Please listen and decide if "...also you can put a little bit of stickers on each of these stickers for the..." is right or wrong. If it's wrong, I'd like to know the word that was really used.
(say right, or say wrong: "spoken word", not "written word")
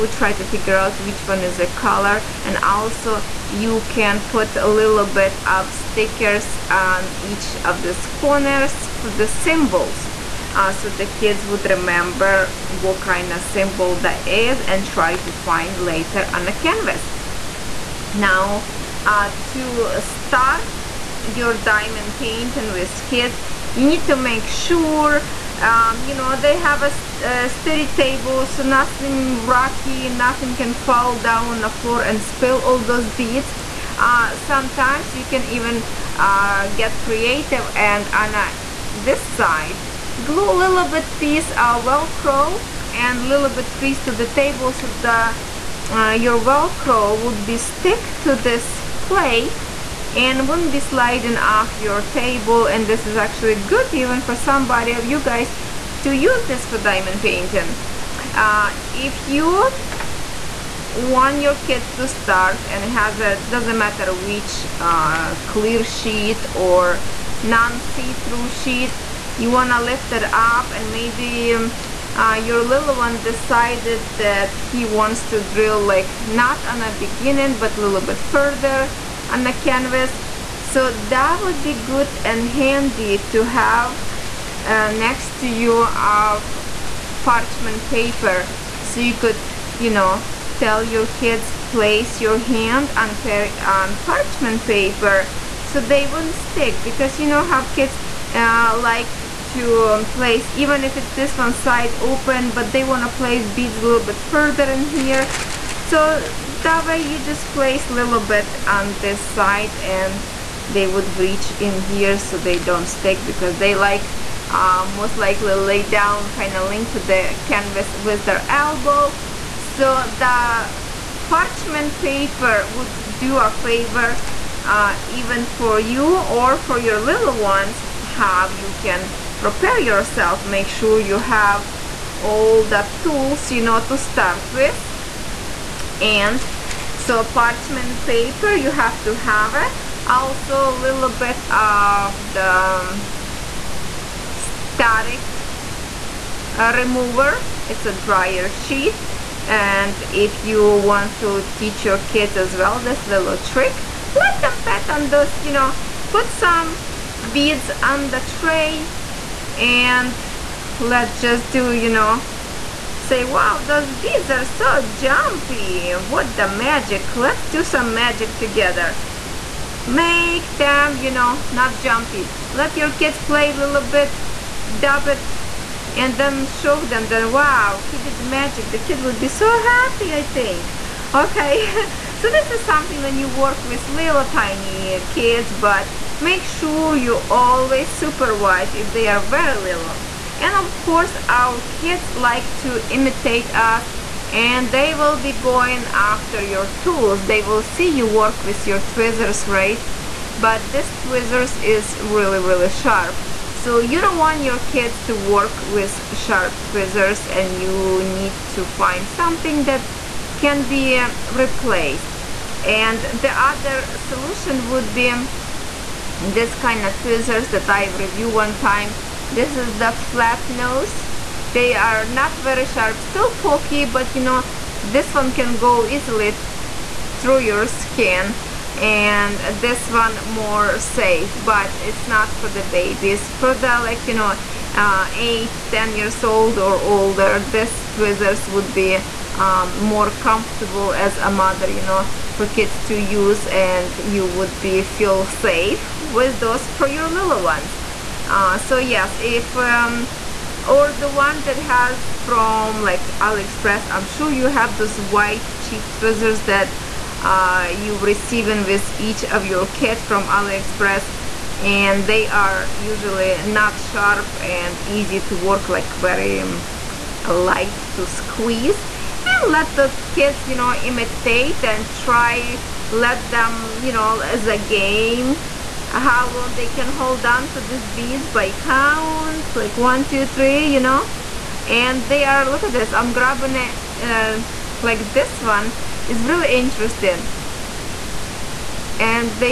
wrong: "corners", not "stickers".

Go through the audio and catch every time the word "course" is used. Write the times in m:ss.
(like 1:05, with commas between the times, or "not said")
3:10.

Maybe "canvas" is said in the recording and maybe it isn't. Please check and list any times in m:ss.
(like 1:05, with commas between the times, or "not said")
0:16, 1:19, 1:57.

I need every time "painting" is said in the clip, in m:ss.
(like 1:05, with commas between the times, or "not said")
0:22, 0:57.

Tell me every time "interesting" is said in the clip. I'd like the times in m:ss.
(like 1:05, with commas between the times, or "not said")
4:46.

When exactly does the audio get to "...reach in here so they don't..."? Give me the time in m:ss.
1:51.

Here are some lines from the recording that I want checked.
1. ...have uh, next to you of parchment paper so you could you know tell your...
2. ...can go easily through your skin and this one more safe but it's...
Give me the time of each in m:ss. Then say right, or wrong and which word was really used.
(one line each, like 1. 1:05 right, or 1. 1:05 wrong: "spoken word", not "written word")
1. 1:23 right
2. 3:45 right.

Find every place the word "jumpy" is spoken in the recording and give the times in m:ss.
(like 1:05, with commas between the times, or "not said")
2:44, 2:51.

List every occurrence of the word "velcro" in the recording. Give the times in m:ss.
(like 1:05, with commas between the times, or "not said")
0:41, 0:46.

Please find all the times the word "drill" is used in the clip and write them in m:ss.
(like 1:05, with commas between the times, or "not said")
1:15.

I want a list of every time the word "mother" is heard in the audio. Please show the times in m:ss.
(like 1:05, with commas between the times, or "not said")
4:01.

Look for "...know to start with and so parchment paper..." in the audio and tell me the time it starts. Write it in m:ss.
2:13.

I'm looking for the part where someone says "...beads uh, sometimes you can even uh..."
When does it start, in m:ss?
0:33.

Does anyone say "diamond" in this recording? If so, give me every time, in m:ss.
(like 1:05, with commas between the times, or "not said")
0:21, 0:56.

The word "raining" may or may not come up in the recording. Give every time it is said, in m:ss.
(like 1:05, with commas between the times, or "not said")
not said.